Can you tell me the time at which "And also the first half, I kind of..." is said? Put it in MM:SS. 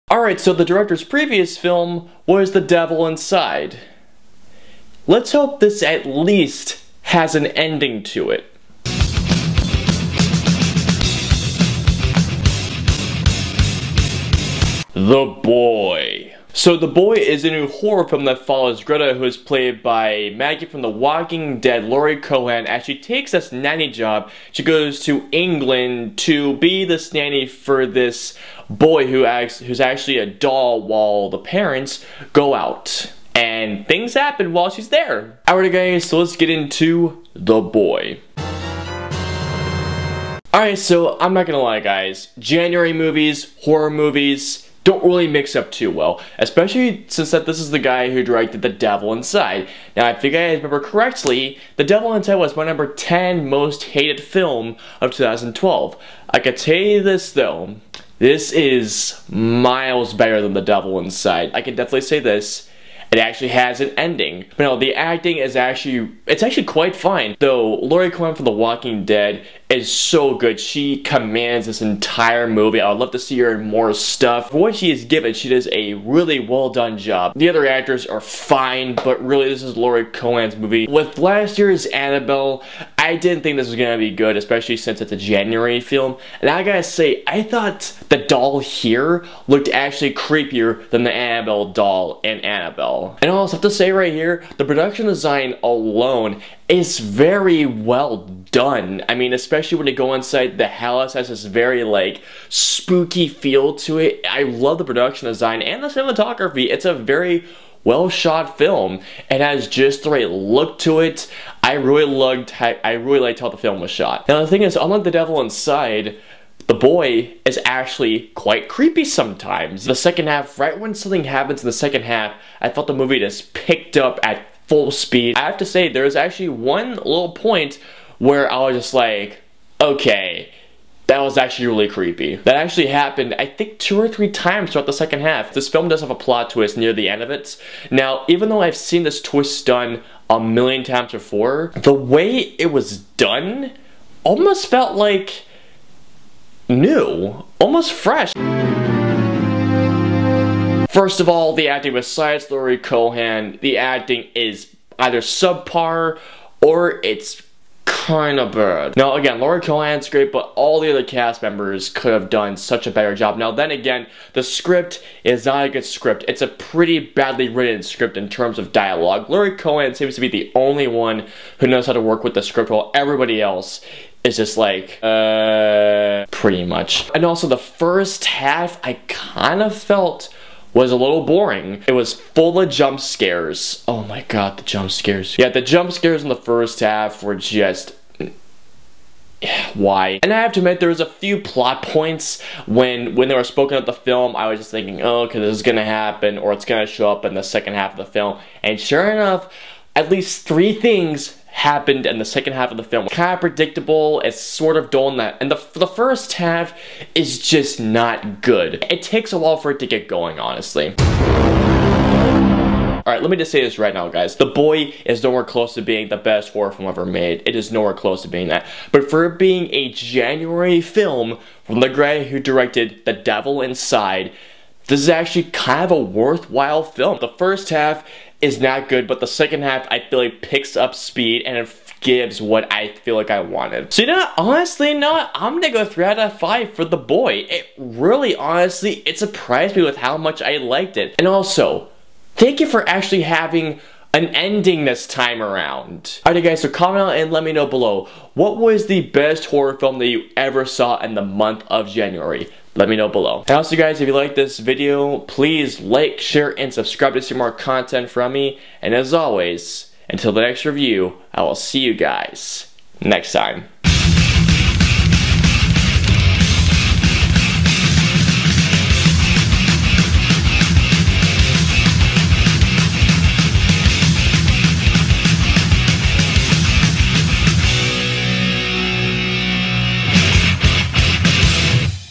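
02:57.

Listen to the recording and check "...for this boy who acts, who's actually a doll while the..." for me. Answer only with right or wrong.
right.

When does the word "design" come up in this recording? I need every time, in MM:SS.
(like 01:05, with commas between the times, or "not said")
01:35, 01:45.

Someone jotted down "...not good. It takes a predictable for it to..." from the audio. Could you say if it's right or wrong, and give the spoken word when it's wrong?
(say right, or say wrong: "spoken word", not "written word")
wrong: "while", not "predictable".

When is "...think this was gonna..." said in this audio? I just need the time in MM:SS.
01:23.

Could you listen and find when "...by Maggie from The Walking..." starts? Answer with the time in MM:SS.
00:19.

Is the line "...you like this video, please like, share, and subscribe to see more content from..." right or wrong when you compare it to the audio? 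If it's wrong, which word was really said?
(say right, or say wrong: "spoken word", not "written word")
right.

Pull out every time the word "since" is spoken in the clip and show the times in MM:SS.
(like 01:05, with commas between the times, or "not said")
00:47, 01:24.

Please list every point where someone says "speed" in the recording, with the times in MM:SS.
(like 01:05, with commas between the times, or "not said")
02:04, 03:50.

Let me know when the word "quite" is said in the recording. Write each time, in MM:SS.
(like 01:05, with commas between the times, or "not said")
01:06, 01:58.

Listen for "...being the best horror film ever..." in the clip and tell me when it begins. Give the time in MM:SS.
03:35.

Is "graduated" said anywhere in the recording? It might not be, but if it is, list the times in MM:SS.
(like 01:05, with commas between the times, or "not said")
not said.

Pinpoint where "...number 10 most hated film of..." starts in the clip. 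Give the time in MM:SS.
00:52.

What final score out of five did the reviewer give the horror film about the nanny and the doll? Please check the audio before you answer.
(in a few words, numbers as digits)
3.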